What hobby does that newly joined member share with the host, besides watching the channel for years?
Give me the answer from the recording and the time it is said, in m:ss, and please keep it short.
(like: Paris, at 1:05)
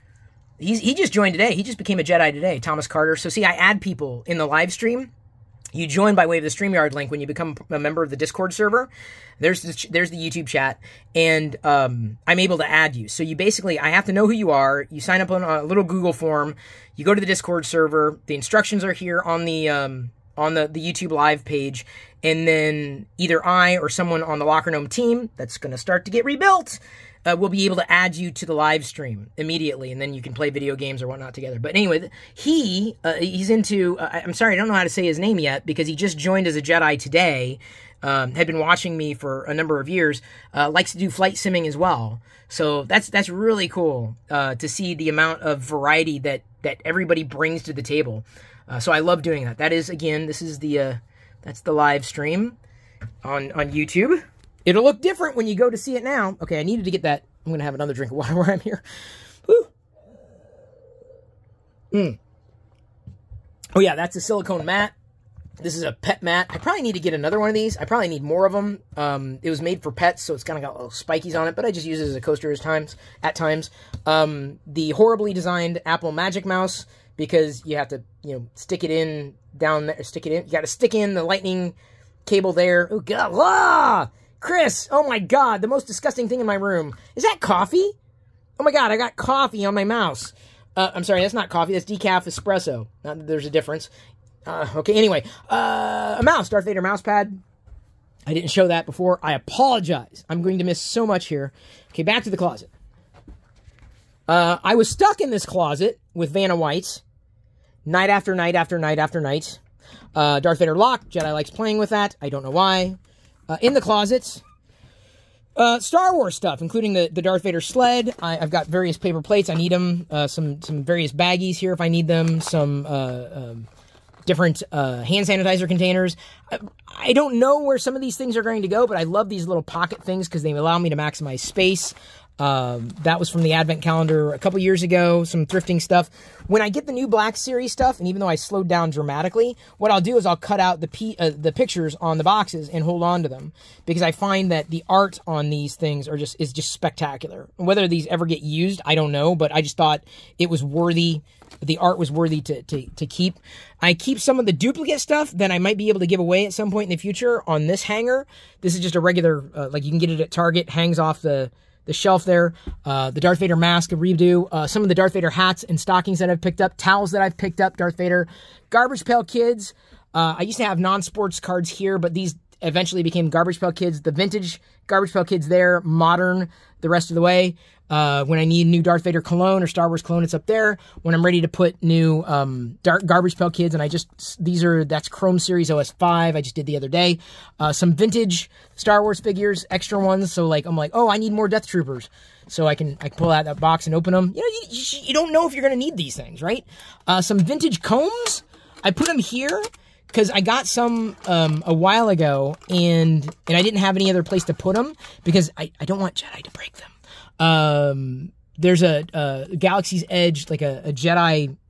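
flight simming, at 0:41.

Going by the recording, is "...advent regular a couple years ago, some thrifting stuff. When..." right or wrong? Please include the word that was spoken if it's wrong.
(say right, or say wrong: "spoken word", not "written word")
wrong: "calendar", not "regular".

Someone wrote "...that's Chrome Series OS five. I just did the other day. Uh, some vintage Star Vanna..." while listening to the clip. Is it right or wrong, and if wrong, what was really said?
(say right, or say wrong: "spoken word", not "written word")
wrong: "Wars", not "Vanna".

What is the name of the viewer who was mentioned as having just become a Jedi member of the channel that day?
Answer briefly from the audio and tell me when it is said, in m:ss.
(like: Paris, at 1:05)
Thomas Carter, at 0:02.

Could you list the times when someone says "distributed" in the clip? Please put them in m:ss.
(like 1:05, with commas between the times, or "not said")
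not said.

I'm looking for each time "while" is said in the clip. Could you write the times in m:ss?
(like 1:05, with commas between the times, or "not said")
0:58, 3:21.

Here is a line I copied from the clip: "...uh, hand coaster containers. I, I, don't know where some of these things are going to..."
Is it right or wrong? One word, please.
wrong.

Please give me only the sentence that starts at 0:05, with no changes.
You join by way of the Streamyard link when you become a member of the Discord server.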